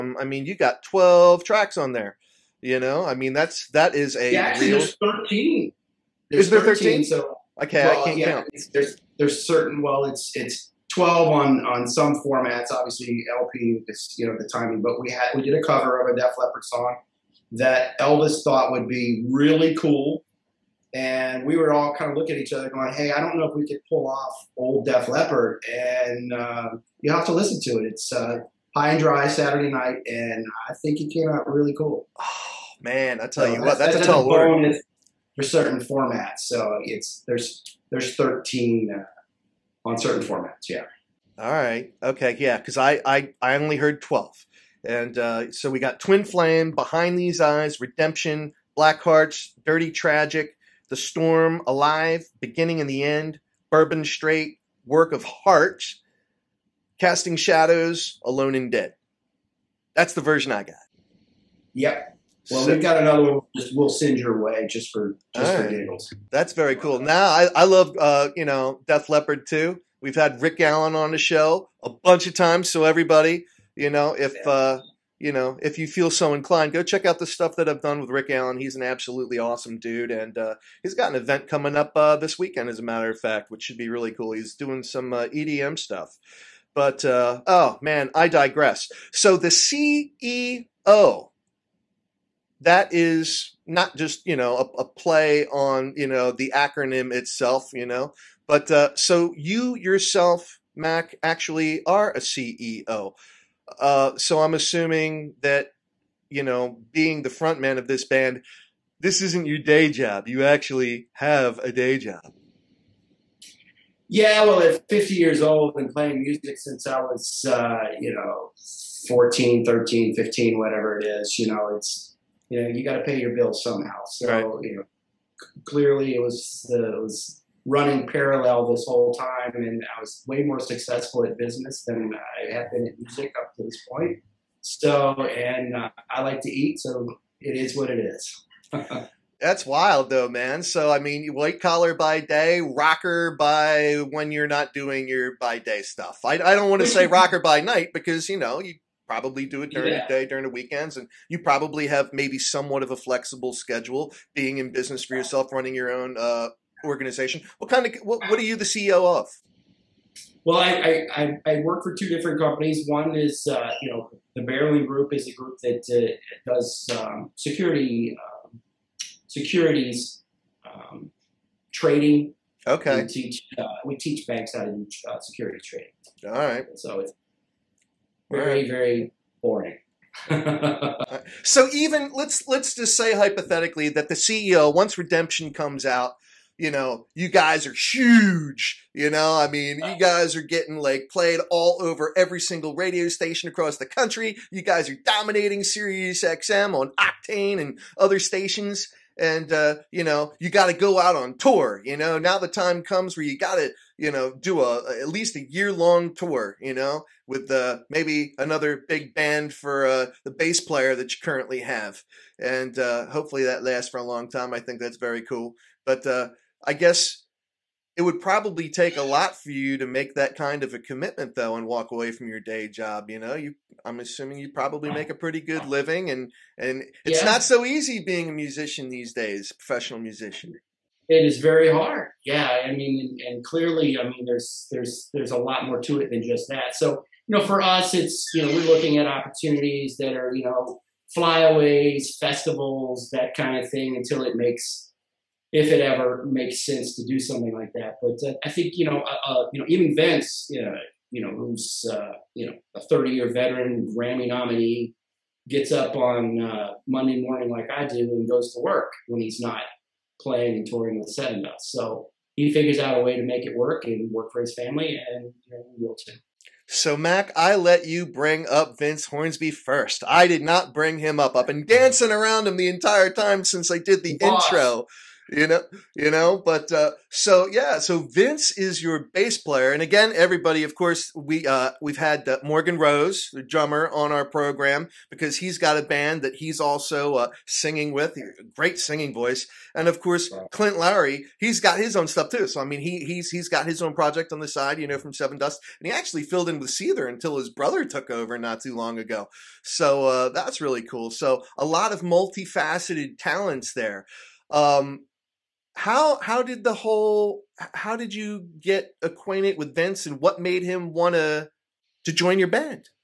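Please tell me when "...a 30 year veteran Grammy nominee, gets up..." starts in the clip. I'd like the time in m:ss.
4:12.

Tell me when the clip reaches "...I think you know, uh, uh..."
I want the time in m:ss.
4:08.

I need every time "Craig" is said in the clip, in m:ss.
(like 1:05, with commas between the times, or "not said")
not said.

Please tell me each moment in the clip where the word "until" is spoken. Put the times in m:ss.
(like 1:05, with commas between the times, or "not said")
4:03, 4:57.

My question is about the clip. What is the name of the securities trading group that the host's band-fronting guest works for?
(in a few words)
Barreling Group.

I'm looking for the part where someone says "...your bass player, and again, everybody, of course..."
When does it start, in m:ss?
4:38.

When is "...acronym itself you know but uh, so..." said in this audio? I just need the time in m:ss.
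1:36.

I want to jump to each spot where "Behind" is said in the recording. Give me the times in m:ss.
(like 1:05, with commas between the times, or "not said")
0:46.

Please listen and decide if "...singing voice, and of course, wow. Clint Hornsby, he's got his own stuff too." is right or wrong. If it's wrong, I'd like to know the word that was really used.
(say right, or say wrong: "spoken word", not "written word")
wrong: "Lowery", not "Hornsby".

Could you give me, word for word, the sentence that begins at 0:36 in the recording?
So it's there's there's 13 uh, on certain formats.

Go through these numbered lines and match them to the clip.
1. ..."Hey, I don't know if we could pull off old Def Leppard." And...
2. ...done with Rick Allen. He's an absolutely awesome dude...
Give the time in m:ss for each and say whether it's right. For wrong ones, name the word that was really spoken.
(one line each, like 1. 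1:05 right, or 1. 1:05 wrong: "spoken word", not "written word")
1. 0:22 right
2. 1:17 right.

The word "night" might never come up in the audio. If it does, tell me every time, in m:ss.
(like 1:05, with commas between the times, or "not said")
0:29, 2:27.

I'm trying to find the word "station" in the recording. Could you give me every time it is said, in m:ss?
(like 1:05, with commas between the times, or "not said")
3:13, 3:18.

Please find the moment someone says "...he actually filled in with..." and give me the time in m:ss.
4:55.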